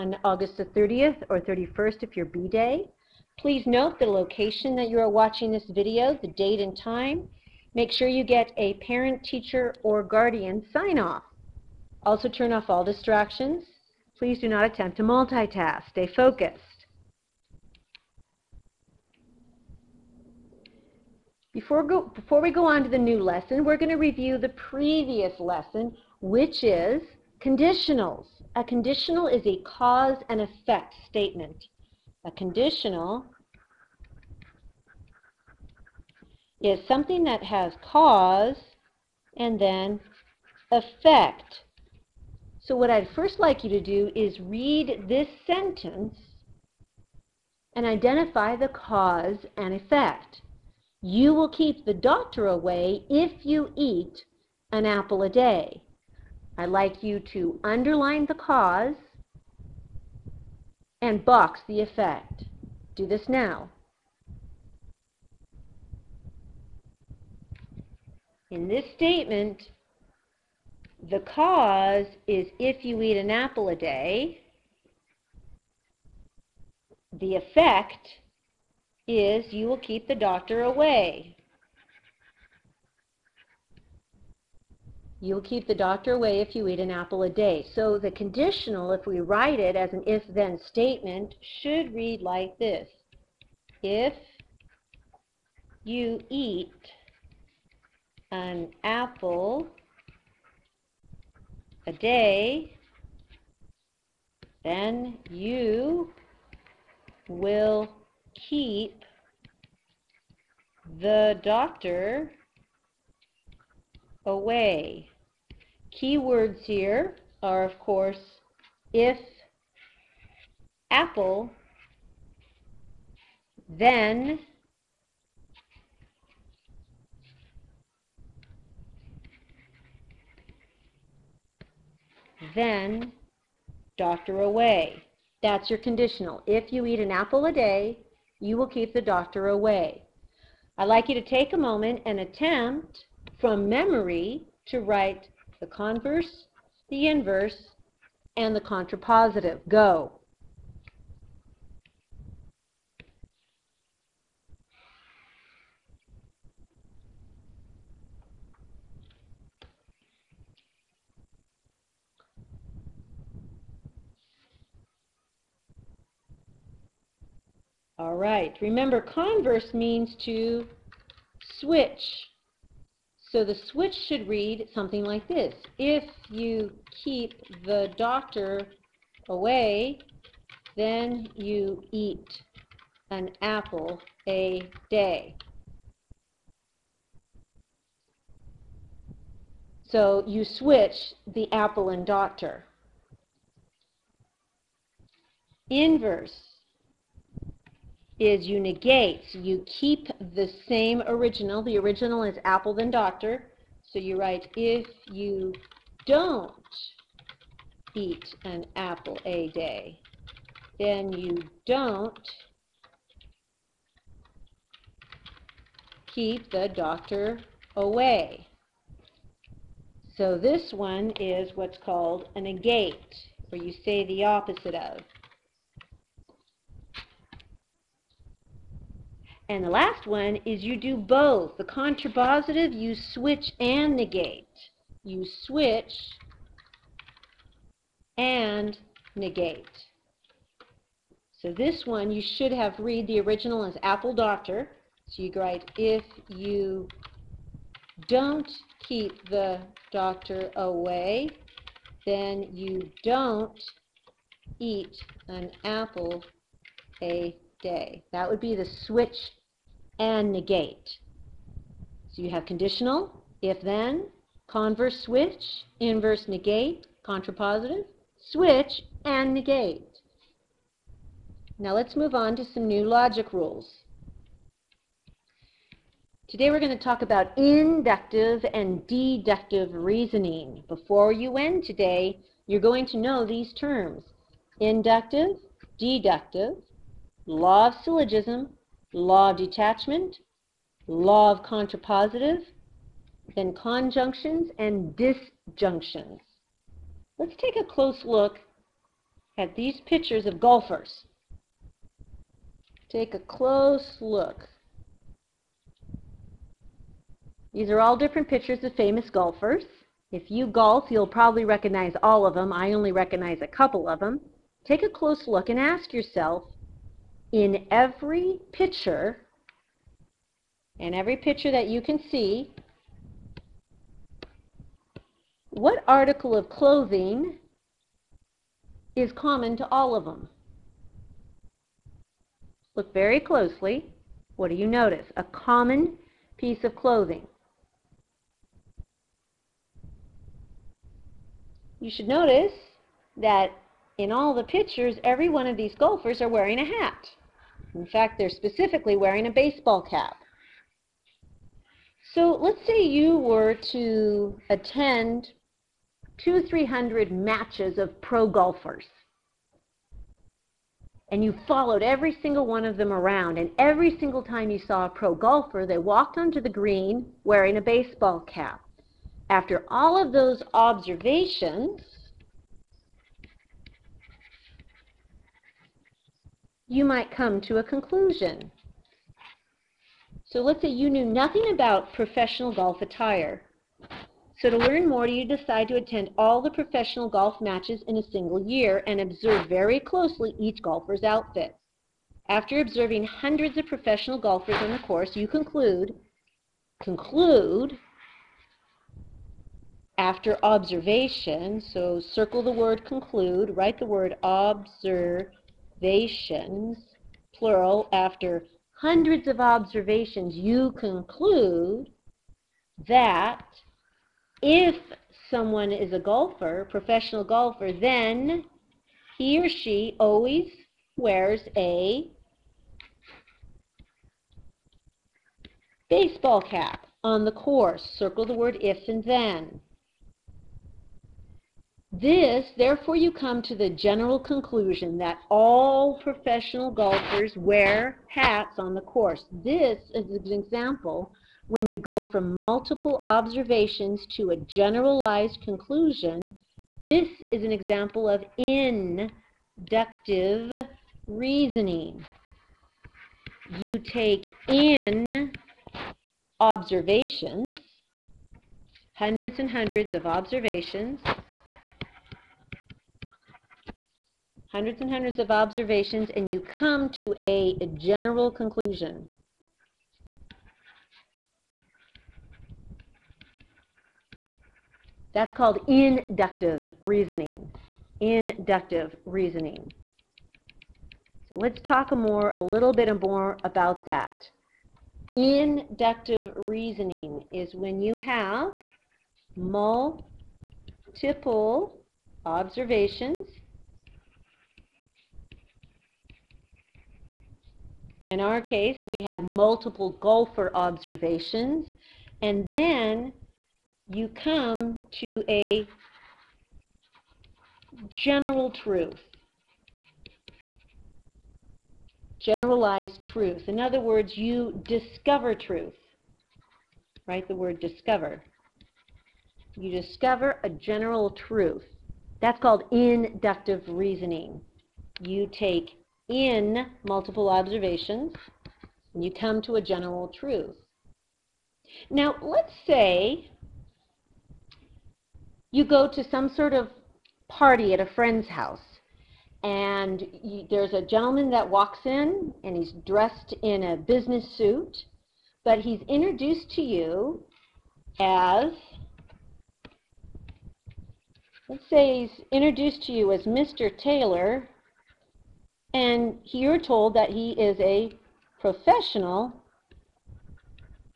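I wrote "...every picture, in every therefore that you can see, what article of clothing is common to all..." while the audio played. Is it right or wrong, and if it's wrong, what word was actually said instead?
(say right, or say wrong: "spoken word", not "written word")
wrong: "picture", not "therefore".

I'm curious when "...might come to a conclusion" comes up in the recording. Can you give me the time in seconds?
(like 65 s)
376 s.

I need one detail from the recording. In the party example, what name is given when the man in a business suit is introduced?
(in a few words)
Mr. Taylor.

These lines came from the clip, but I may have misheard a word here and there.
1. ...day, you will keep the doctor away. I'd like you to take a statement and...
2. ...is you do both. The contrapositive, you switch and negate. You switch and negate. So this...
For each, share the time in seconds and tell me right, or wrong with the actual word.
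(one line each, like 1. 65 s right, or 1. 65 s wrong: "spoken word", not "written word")
1. 137 s wrong: "moment", not "statement"
2. 230 s right.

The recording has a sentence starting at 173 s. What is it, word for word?
So the switch should read something like this.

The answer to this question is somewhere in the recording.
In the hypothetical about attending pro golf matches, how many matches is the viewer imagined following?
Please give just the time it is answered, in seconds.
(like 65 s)
356 s.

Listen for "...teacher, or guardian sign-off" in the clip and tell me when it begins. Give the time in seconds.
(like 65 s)
9 s.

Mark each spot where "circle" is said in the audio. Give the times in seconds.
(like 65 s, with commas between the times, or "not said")
402 s, 427 s.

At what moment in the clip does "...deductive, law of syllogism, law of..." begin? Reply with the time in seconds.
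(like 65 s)
285 s.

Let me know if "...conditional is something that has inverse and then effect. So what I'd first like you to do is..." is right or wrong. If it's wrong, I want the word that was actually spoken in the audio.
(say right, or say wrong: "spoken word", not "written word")
wrong: "cause", not "inverse".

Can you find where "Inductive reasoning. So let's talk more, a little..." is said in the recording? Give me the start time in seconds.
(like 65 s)
478 s.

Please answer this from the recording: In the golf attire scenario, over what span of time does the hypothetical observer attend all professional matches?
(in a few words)
a single year.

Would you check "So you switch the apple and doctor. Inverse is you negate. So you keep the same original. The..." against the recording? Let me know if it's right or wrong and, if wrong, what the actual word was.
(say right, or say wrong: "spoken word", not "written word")
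right.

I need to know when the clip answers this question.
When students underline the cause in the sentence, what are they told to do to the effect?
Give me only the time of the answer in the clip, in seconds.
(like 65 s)
61 s.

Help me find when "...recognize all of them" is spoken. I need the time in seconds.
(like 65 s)
311 s.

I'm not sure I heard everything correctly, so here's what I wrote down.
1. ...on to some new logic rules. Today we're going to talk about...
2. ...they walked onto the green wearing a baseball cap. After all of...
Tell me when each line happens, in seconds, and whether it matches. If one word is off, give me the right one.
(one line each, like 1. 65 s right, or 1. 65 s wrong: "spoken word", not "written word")
1. 272 s right
2. 365 s right.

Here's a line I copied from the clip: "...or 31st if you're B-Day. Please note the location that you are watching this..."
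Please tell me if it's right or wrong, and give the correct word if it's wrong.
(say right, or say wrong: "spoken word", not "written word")
right.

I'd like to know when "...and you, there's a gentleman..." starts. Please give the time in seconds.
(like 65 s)
539 s.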